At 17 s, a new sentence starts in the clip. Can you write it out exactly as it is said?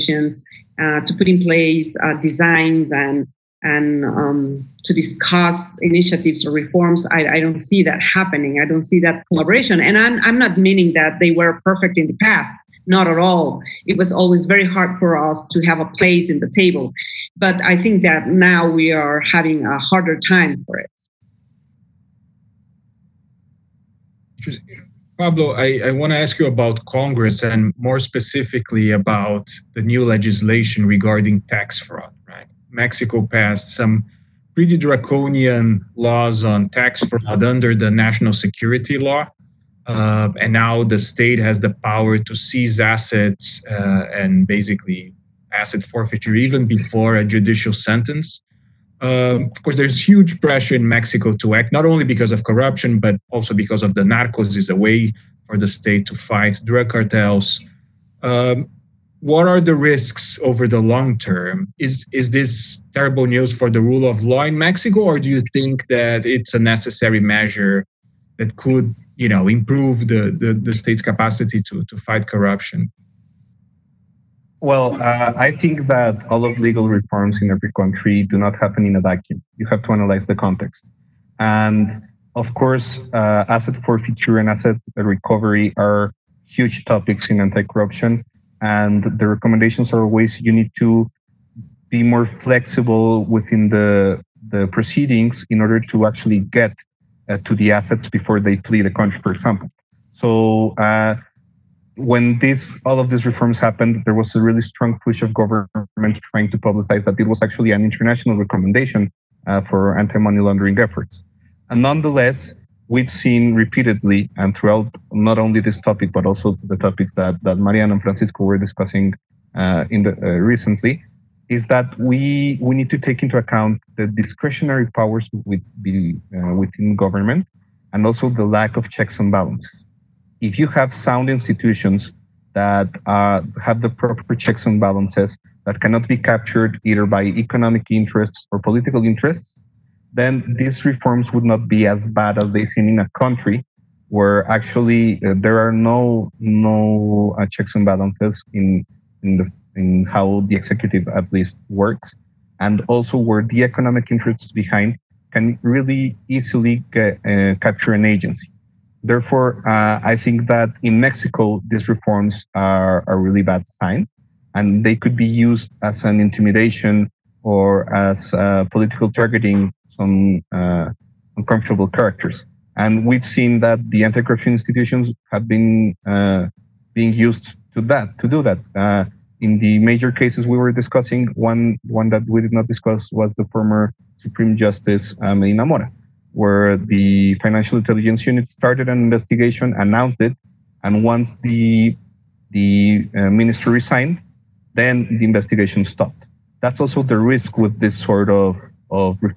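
But I think that now we are having a harder time for it.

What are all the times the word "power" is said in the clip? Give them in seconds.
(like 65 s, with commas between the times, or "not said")
41 s, 124 s.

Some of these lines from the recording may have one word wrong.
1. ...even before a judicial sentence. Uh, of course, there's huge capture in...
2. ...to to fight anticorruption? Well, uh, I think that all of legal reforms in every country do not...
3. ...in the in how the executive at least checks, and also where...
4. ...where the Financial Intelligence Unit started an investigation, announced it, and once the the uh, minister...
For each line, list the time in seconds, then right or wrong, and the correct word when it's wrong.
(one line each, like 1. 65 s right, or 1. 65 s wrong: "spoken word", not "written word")
1. 46 s wrong: "pressure", not "capture"
2. 71 s wrong: "corruption", not "anticorruption"
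3. 149 s wrong: "works", not "checks"
4. 186 s right.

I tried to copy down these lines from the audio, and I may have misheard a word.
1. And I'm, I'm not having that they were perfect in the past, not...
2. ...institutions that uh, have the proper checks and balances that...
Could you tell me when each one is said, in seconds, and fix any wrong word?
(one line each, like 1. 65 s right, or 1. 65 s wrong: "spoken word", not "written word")
1. 9 s wrong: "meaning", not "having"
2. 131 s right.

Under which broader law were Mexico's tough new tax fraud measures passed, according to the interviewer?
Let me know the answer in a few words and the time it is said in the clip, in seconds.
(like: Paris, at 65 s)
National security law, at 37 s.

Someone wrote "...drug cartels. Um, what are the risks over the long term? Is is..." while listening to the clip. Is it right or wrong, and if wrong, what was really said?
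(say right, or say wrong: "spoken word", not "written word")
right.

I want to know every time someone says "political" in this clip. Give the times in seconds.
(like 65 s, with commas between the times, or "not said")
138 s, 168 s.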